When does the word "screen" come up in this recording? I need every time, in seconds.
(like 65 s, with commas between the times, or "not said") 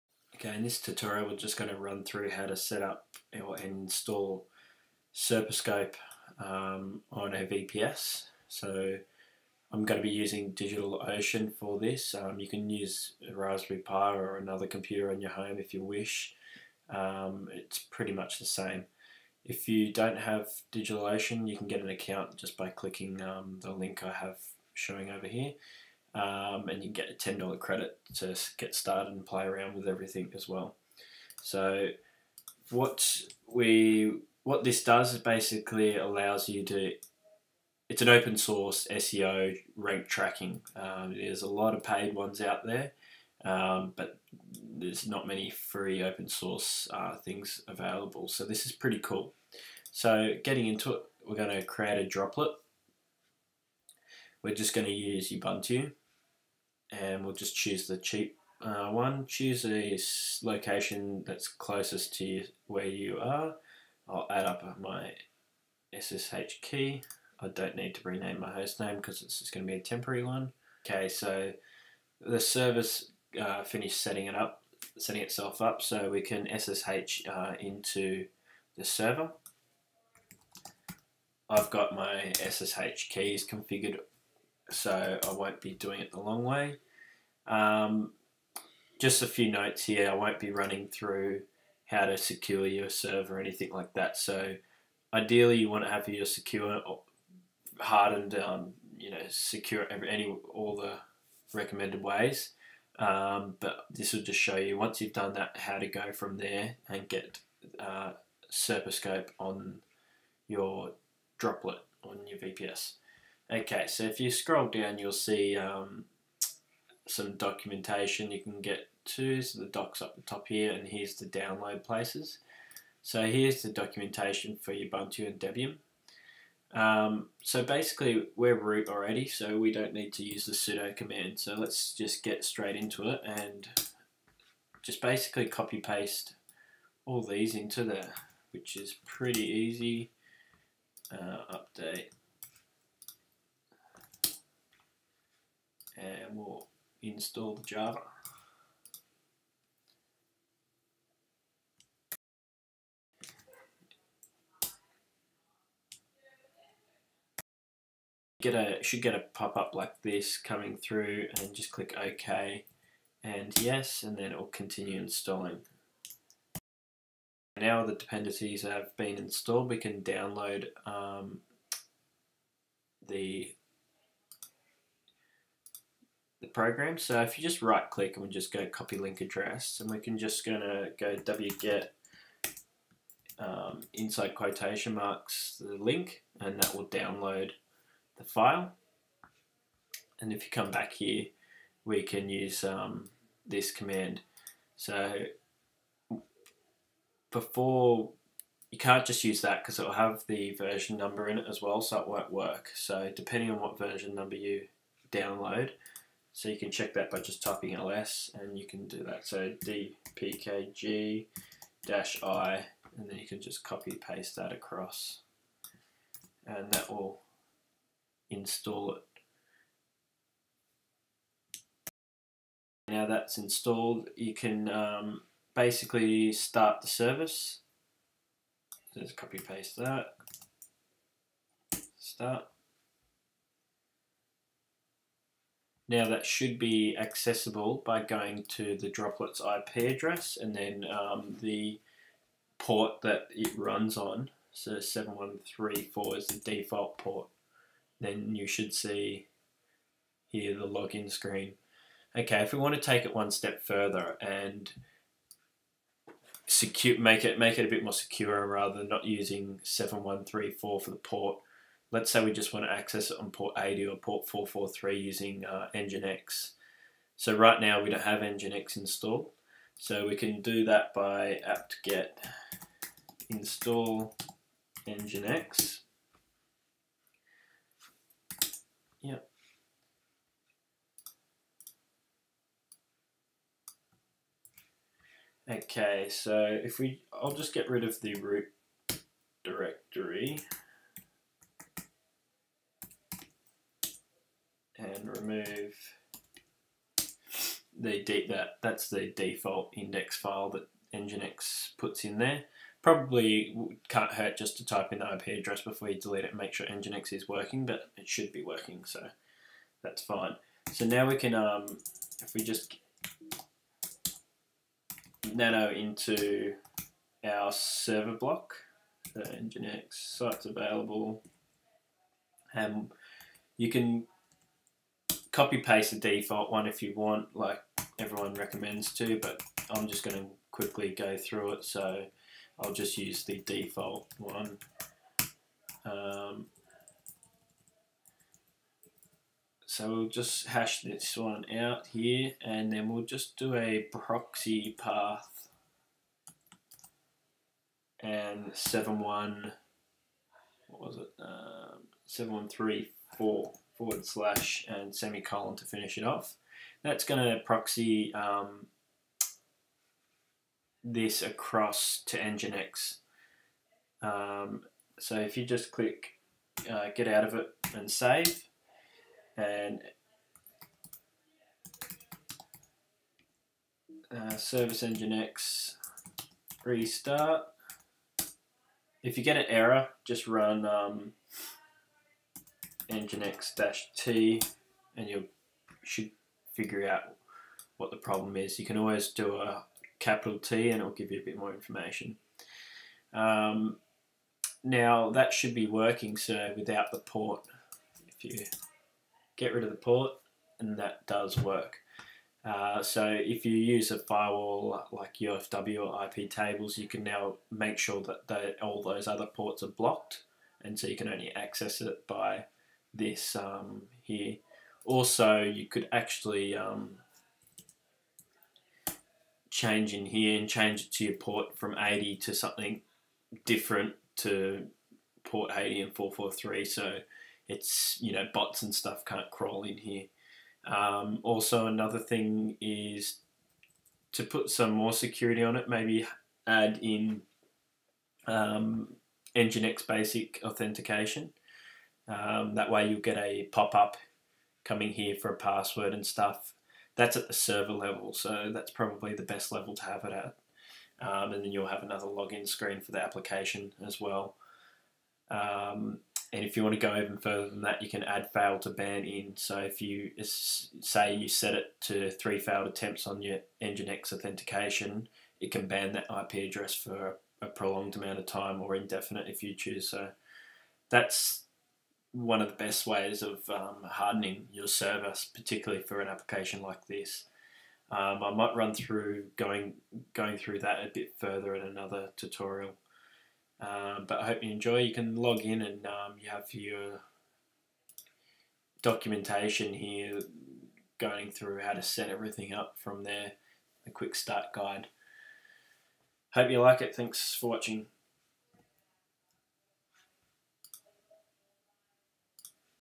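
251 s, 452 s.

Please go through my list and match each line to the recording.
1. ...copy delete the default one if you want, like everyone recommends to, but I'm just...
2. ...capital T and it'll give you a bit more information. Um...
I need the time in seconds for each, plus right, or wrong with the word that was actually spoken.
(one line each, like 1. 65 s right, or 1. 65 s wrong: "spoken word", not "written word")
1. 325 s wrong: "paste", not "delete"
2. 389 s right.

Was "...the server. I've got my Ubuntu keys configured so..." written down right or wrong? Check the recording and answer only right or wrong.
wrong.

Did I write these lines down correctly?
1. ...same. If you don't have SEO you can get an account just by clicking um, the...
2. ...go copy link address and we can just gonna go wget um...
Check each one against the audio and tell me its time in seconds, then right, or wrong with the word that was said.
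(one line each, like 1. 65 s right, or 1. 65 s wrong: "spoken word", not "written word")
1. 18 s wrong: "DigitalOcean", not "SEO"
2. 178 s right.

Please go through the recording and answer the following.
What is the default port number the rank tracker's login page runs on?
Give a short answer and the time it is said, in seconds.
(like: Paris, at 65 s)
7134, at 244 s.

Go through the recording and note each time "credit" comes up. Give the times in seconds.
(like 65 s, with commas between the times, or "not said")
27 s.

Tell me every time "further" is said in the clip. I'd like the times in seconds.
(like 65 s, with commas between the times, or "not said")
253 s, 457 s, 481 s.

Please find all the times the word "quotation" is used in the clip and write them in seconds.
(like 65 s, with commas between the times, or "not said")
184 s.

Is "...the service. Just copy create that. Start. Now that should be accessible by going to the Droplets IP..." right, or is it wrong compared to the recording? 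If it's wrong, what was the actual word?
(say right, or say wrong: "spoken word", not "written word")
wrong: "paste", not "create".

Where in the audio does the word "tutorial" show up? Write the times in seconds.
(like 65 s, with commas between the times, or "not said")
0 s, 482 s.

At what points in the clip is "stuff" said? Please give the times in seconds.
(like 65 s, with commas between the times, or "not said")
428 s, 446 s.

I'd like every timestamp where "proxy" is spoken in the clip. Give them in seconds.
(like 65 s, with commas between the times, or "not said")
343 s, 357 s.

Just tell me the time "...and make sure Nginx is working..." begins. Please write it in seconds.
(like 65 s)
306 s.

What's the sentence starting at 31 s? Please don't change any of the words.
So what we what this does is basically allows you to it's an open source SEO rank tracking.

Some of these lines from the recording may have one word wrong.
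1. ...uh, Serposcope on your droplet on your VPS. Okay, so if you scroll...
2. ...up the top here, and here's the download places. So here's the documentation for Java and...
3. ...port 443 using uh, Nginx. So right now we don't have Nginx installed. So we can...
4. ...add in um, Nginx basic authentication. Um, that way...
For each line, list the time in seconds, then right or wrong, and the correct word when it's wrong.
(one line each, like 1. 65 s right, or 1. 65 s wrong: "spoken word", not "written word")
1. 107 s right
2. 120 s wrong: "Ubuntu", not "Java"
3. 263 s right
4. 436 s right.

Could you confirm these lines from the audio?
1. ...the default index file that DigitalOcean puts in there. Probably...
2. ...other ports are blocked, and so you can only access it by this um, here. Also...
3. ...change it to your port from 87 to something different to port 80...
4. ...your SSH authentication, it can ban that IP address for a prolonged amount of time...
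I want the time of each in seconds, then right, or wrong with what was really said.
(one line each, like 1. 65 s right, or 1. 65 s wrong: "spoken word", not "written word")
1. 298 s wrong: "Nginx", not "DigitalOcean"
2. 409 s right
3. 420 s wrong: "80", not "87"
4. 463 s wrong: "Nginx", not "SSH".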